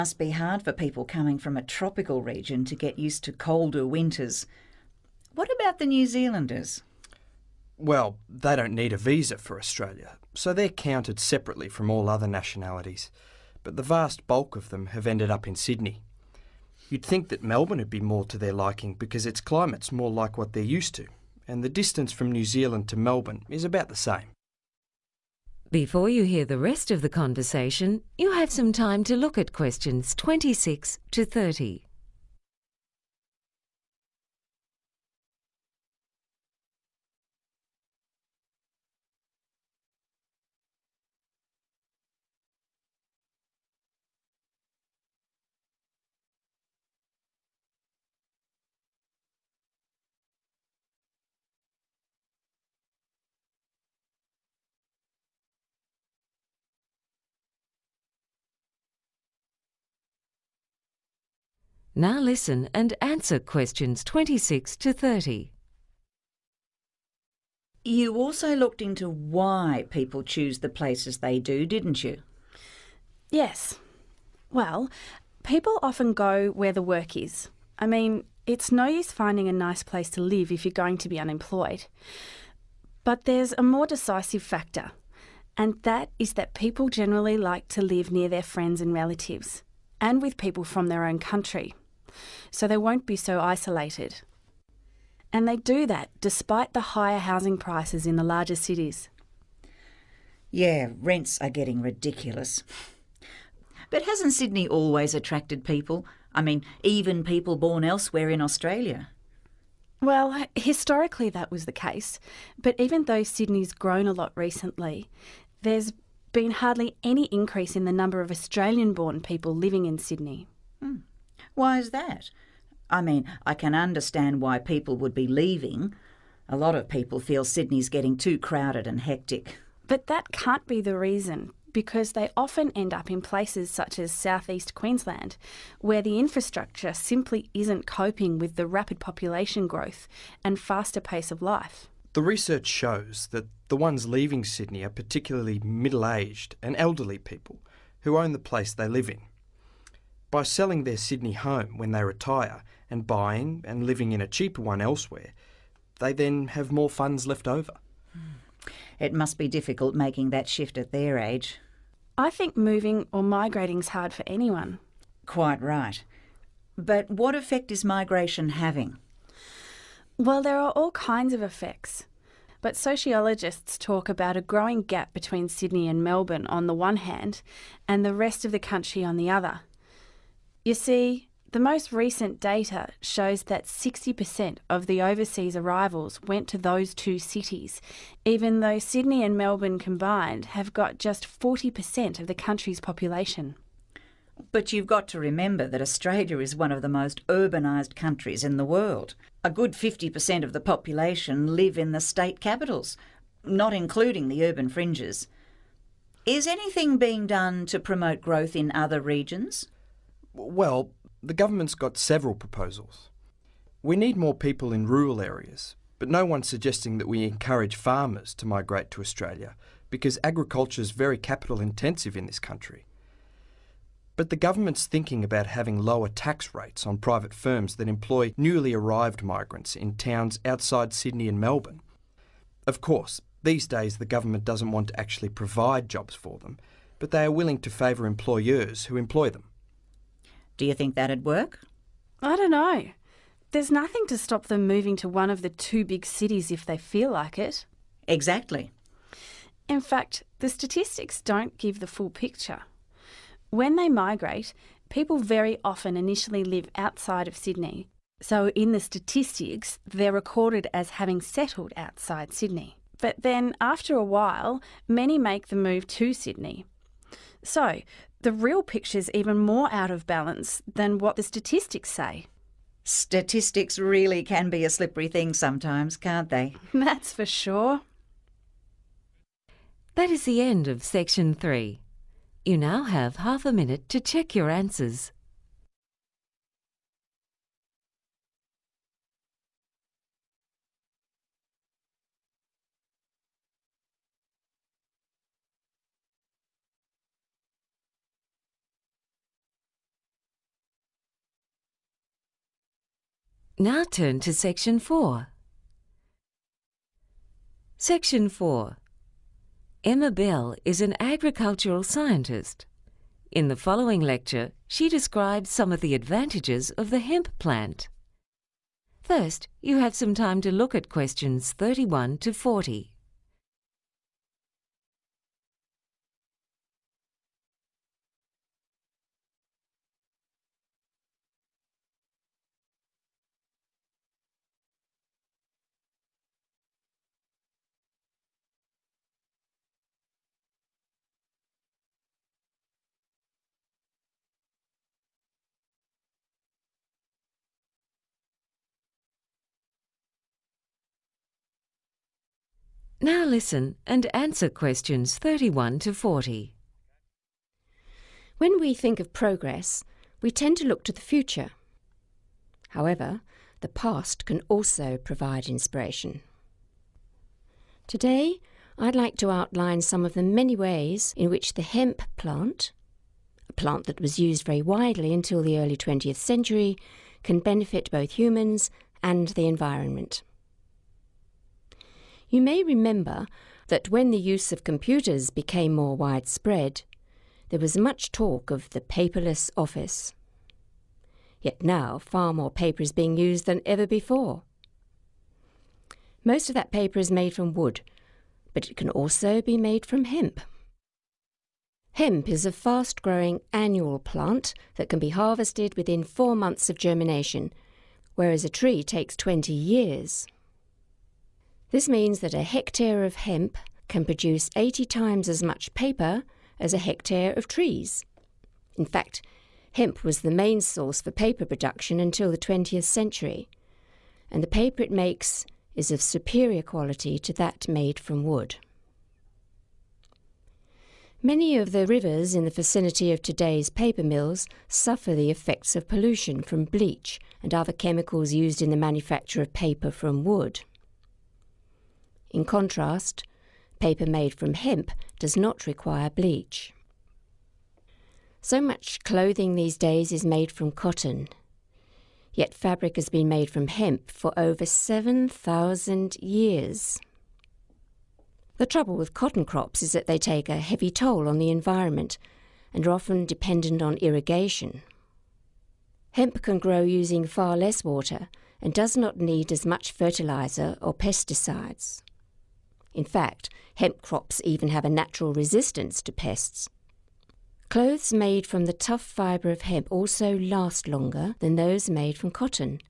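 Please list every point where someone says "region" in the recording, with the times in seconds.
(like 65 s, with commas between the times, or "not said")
2 s, 209 s.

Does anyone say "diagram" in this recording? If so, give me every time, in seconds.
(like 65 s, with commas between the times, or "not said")
not said.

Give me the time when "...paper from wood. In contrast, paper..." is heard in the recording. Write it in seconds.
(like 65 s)
439 s.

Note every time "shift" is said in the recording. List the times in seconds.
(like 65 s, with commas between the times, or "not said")
160 s.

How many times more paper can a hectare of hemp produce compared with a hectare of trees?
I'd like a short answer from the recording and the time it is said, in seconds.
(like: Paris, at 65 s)
80, at 414 s.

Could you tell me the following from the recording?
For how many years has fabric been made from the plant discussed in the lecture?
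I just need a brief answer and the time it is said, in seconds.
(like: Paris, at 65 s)
7,000, at 454 s.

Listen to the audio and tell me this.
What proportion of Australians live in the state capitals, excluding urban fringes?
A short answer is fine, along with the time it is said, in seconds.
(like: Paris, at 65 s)
50%, at 199 s.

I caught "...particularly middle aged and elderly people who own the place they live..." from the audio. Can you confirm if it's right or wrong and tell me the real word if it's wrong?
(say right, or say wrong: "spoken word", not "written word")
right.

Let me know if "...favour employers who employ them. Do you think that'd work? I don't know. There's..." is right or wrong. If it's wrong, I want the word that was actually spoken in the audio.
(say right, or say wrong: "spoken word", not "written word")
right.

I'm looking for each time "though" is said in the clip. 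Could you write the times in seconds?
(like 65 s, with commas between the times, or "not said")
113 s, 188 s.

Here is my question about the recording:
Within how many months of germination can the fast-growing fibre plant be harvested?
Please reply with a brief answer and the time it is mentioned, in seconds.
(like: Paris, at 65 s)
4, at 406 s.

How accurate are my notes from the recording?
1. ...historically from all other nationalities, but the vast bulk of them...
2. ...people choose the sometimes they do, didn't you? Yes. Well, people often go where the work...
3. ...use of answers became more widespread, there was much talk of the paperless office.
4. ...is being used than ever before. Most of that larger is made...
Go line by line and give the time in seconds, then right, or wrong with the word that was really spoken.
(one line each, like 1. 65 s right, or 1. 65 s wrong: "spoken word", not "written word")
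1. 11 s wrong: "separately", not "historically"
2. 69 s wrong: "places", not "sometimes"
3. 384 s wrong: "computers", not "answers"
4. 392 s wrong: "paper", not "larger".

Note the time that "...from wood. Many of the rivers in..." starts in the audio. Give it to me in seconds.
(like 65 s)
427 s.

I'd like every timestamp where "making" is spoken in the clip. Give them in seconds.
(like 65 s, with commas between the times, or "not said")
159 s.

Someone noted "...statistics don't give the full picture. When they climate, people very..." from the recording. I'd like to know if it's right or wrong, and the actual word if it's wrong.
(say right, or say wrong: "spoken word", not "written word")
wrong: "migrate", not "climate".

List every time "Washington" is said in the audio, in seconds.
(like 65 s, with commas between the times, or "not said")
not said.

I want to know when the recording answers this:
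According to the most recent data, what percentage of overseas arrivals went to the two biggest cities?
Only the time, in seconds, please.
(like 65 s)
183 s.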